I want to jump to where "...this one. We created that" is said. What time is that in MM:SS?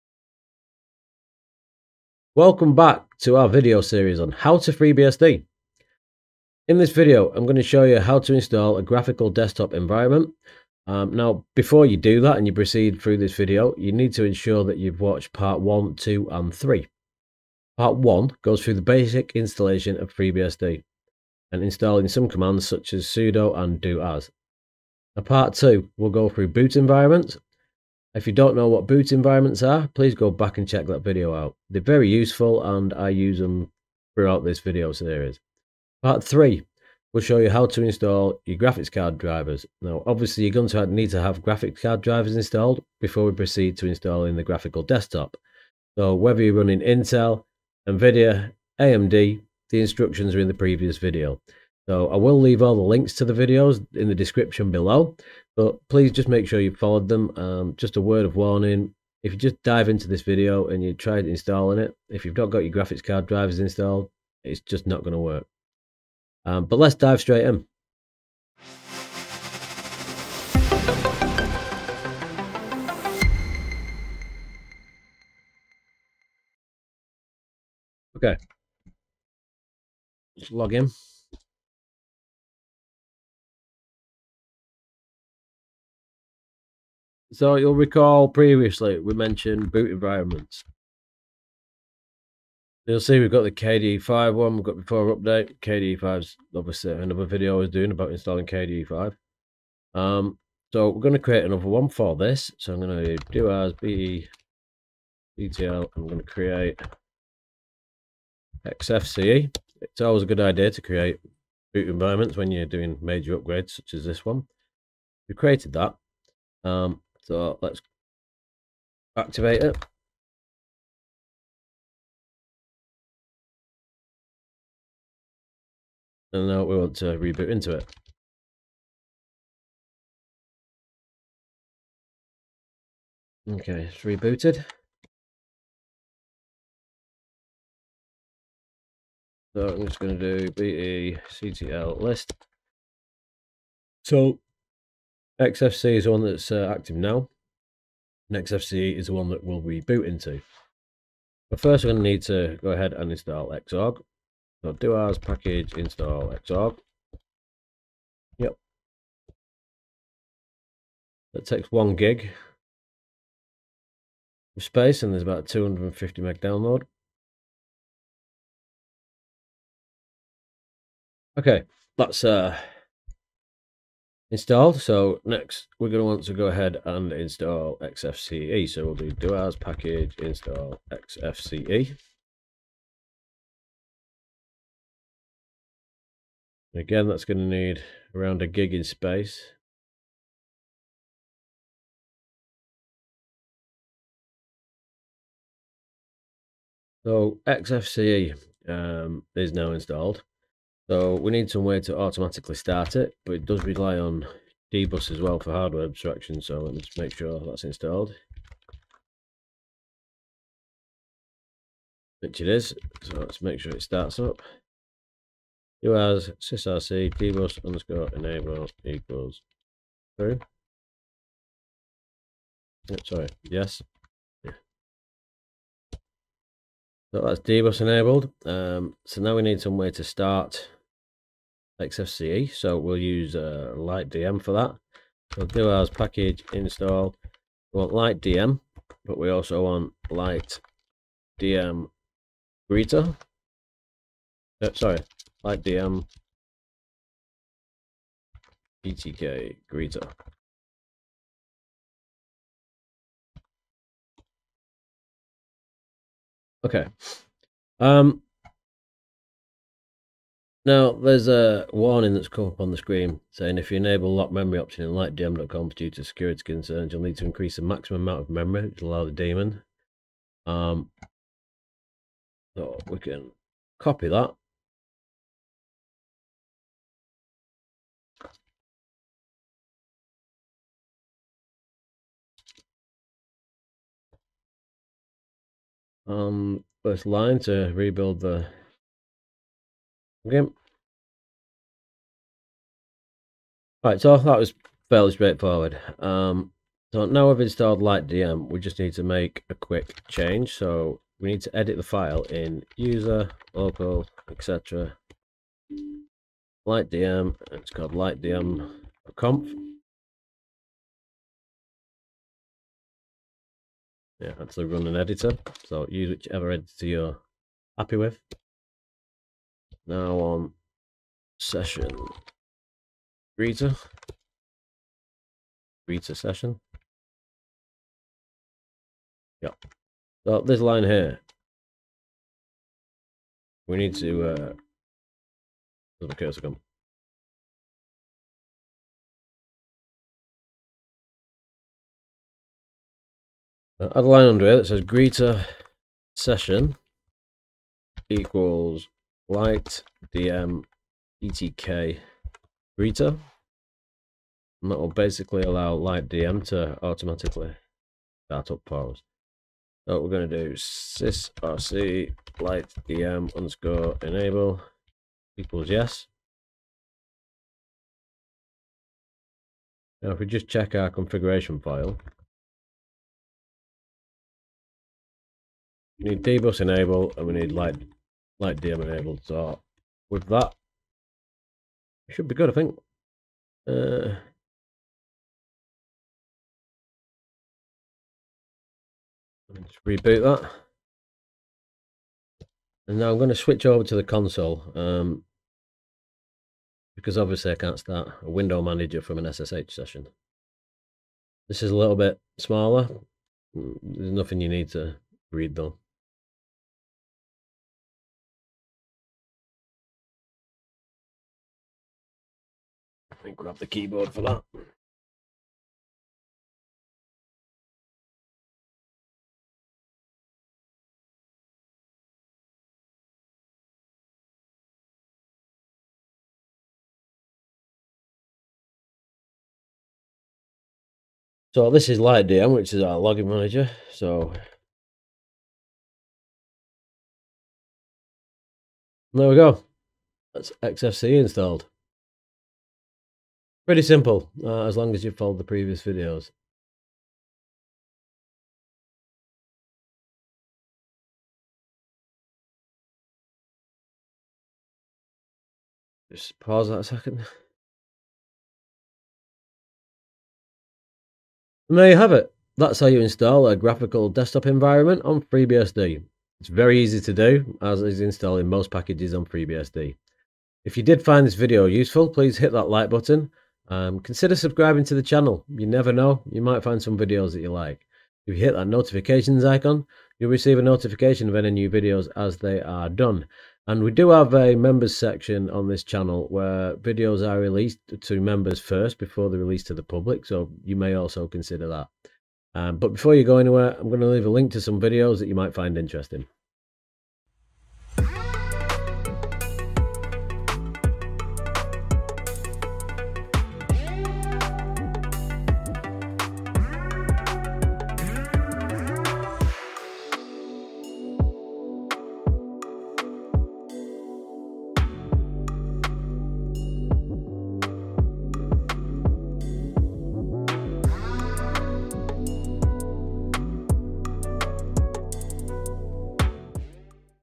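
01:54.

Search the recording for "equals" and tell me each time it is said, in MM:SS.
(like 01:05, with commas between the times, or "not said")
03:38, 05:48, 06:05.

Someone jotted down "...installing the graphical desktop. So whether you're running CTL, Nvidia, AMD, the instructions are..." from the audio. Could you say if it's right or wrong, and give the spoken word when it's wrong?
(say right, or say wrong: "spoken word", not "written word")
wrong: "Intel", not "CTL".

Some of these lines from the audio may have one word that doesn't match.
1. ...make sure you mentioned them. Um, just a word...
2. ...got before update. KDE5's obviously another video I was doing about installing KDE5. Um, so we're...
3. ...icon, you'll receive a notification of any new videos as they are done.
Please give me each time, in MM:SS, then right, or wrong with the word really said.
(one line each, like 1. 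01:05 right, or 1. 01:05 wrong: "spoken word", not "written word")
1. 00:56 wrong: "followed", not "mentioned"
2. 01:34 right
3. 07:59 right.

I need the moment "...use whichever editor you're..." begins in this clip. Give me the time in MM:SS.
05:15.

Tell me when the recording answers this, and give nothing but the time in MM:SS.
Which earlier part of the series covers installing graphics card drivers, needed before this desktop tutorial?
00:36.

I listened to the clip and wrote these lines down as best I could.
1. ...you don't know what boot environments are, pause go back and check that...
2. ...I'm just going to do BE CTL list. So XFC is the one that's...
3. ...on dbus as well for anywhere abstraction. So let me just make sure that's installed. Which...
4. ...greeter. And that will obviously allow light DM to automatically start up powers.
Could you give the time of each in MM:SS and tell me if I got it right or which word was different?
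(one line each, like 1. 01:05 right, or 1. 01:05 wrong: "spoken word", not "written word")
1. 00:28 wrong: "please", not "pause"
2. 02:19 right
3. 03:23 wrong: "hardware", not "anywhere"
4. 05:52 wrong: "basically", not "obviously".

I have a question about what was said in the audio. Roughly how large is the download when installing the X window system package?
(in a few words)
250 MB.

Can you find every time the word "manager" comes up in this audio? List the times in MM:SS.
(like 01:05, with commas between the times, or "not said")
06:38, 07:13.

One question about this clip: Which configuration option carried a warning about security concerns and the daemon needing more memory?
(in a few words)
lock memory option.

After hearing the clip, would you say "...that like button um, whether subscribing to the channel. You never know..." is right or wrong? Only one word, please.
wrong.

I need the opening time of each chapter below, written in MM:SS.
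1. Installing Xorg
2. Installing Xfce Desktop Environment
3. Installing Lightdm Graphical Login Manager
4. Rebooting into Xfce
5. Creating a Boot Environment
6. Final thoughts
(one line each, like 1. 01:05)
1. 02:30
2. 02:50
3. 03:48
4. 06:24
5. 01:17
6. 07:40.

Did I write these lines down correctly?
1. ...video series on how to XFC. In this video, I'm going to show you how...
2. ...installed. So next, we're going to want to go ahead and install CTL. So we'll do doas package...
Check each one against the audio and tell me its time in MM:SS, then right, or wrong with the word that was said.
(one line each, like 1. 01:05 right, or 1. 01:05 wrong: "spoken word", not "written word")
1. 00:03 wrong: "FreeBSD", not "XFC"
2. 02:54 wrong: "XFCE", not "CTL".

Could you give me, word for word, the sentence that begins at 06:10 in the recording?
Now if we just check our configuration file, we need dbus enable and we need light like DM enabled.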